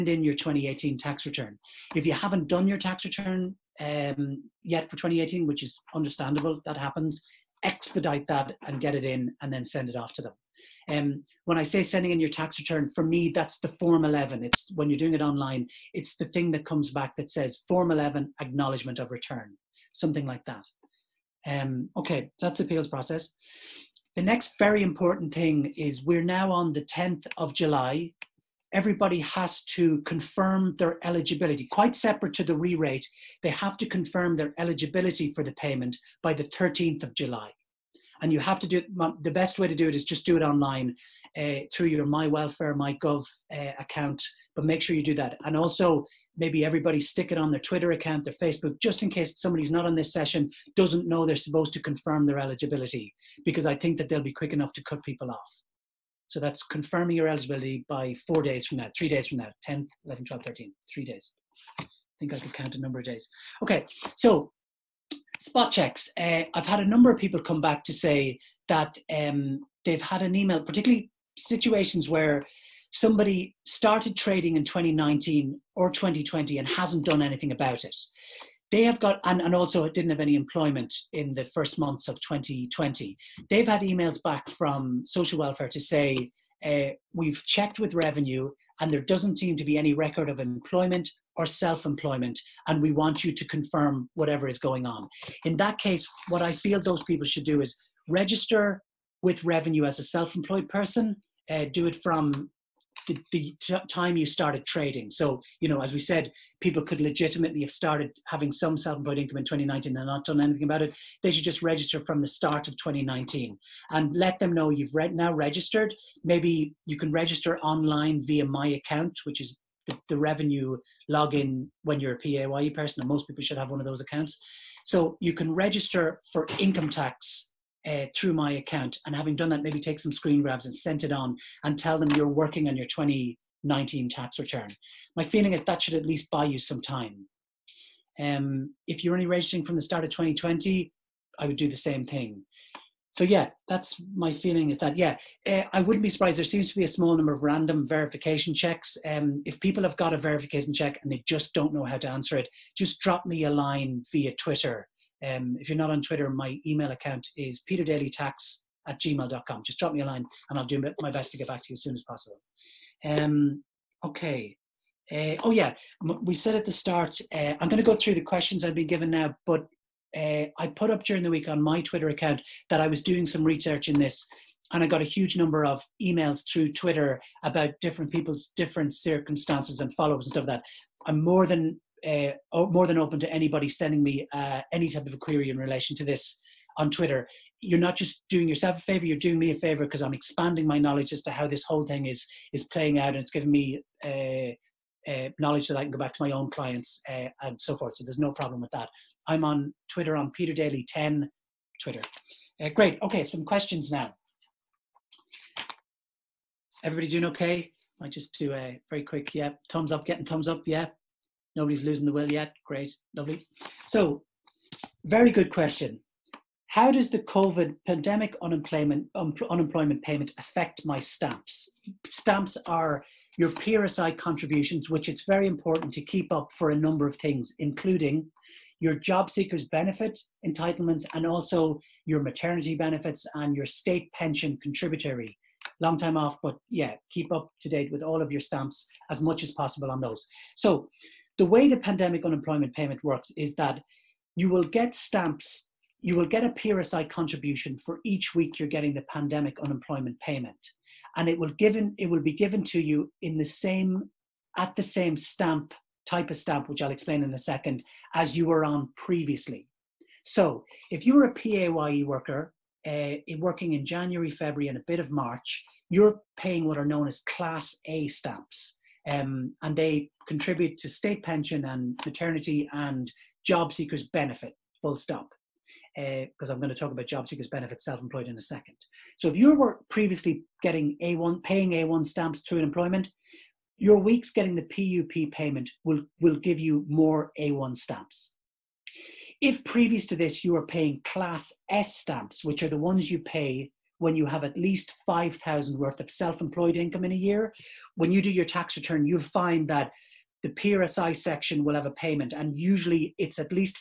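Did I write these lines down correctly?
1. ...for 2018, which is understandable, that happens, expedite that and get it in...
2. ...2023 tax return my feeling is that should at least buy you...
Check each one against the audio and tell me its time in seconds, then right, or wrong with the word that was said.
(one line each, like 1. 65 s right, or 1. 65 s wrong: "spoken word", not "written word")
1. 4 s right
2. 132 s wrong: "2019", not "2023".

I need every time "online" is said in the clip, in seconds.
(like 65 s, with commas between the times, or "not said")
15 s, 40 s, 117 s.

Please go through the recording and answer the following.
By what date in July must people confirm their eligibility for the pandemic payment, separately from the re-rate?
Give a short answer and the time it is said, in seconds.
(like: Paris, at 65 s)
13th of July, at 36 s.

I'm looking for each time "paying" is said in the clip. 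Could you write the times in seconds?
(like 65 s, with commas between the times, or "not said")
266 s, 281 s, 290 s.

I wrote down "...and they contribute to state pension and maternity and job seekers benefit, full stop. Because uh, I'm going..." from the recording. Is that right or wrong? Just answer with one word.
right.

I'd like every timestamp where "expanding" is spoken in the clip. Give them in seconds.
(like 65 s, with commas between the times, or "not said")
190 s.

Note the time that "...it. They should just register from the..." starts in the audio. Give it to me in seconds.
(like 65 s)
110 s.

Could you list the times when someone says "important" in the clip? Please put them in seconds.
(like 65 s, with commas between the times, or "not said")
24 s, 225 s.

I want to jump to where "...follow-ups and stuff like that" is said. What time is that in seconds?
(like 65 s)
179 s.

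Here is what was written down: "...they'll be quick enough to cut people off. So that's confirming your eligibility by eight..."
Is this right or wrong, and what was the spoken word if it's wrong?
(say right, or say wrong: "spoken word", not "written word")
wrong: "four", not "eight".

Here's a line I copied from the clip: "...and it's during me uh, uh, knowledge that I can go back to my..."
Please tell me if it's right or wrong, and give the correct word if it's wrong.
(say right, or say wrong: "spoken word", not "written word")
wrong: "giving", not "during".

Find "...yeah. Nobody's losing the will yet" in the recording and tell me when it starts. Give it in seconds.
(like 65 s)
210 s.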